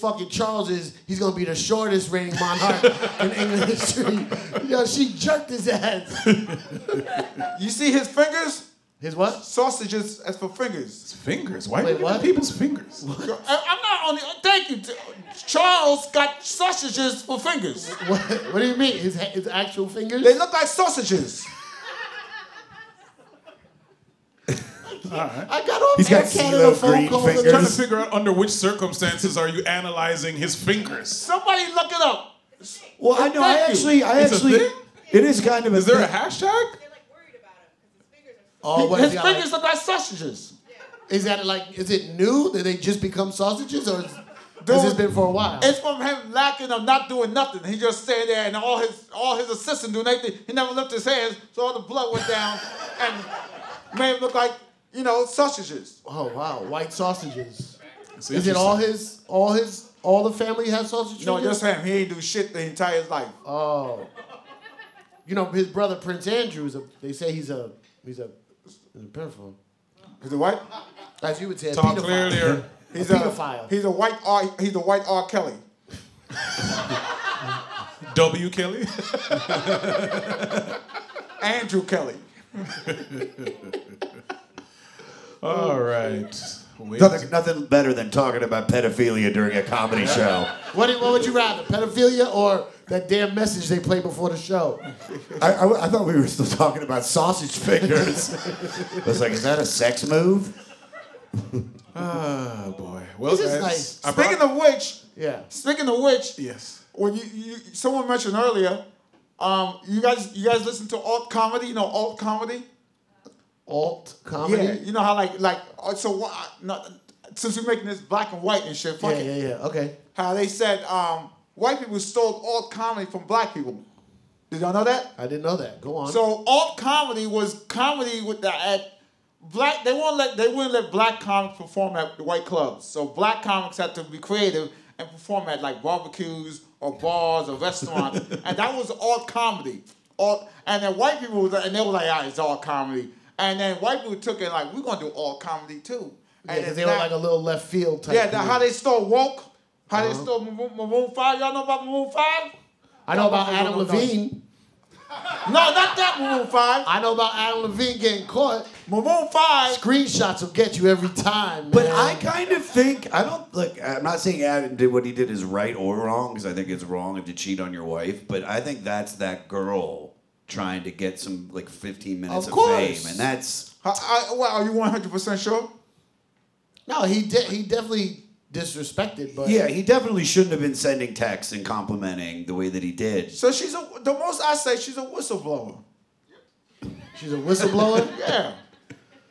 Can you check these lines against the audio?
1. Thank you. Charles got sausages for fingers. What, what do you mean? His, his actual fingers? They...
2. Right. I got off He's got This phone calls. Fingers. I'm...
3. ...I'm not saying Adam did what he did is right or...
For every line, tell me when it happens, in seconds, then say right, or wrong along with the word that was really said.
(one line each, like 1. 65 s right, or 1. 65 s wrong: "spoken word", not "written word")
1. 14 s right
2. 25 s wrong: "Canada", not "This"
3. 163 s right.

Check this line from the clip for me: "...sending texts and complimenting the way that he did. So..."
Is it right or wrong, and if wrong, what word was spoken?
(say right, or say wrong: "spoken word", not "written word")
right.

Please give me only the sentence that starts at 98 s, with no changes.
I was like, is that a sex move?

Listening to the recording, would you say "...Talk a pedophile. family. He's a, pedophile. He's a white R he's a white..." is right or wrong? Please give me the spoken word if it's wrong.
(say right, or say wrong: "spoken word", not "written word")
wrong: "clearly", not "family".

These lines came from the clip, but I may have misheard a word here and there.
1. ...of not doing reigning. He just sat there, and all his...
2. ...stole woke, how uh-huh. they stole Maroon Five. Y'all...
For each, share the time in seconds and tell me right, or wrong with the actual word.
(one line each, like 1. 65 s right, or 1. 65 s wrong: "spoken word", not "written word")
1. 46 s wrong: "nothing", not "reigning"
2. 148 s right.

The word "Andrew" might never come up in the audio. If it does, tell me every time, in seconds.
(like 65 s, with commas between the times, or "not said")
66 s, 81 s.